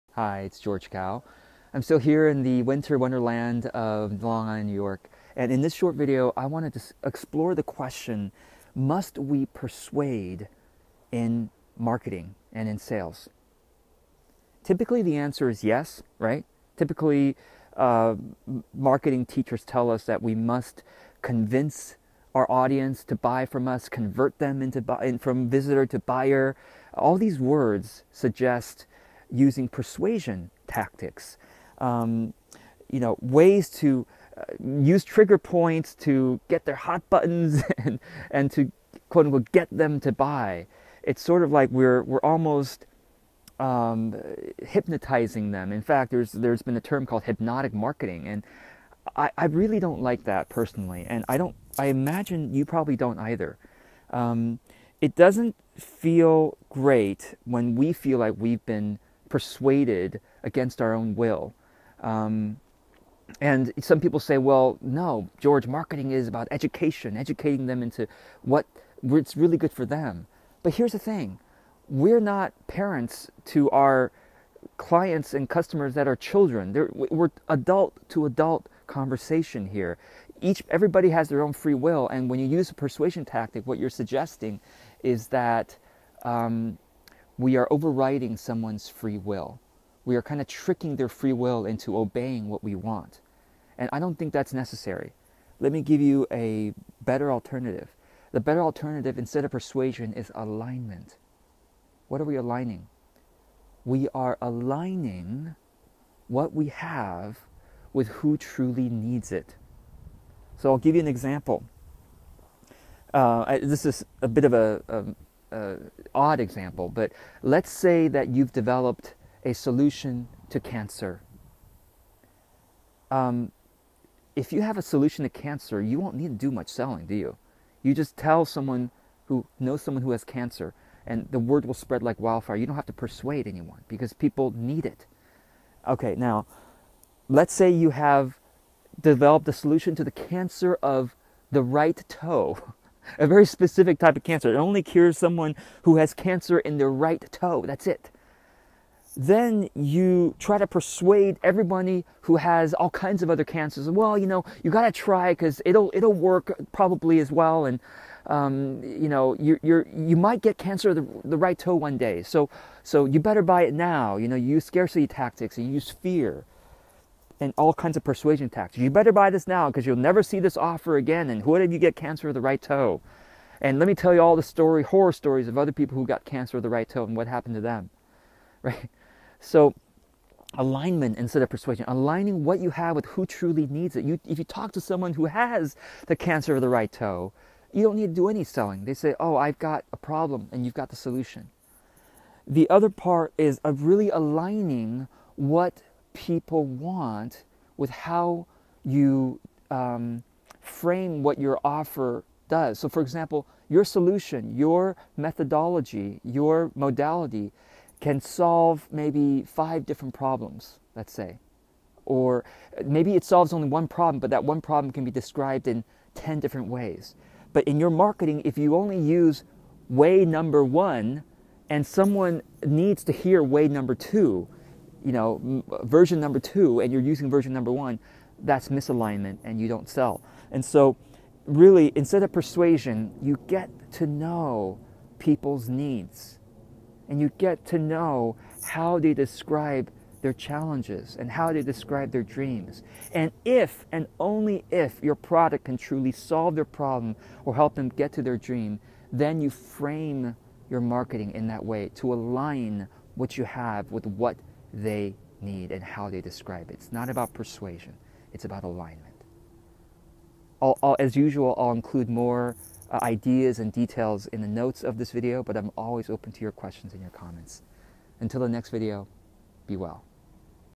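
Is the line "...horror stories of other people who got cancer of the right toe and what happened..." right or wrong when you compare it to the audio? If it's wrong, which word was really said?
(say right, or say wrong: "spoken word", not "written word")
right.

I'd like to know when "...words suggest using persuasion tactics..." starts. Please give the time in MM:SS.
00:27.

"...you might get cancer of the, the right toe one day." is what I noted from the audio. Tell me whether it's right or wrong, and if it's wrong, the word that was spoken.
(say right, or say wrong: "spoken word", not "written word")
right.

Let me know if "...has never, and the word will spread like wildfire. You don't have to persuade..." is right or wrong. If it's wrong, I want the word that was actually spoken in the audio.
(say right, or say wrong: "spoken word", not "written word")
wrong: "cancer", not "never".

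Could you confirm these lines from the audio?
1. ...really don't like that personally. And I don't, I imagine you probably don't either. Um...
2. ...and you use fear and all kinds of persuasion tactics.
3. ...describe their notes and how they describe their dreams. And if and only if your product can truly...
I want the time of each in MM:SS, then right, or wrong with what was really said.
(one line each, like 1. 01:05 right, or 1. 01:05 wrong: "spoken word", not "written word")
1. 00:49 right
2. 02:45 right
3. 03:59 wrong: "challenges", not "notes".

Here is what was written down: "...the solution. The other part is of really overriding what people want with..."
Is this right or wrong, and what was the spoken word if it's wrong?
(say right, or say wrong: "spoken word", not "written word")
wrong: "aligning", not "overriding".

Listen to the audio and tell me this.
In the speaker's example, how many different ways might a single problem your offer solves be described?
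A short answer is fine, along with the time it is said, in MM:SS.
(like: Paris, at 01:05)
10, at 03:36.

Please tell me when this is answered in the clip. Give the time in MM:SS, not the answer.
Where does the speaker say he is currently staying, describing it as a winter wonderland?
00:04.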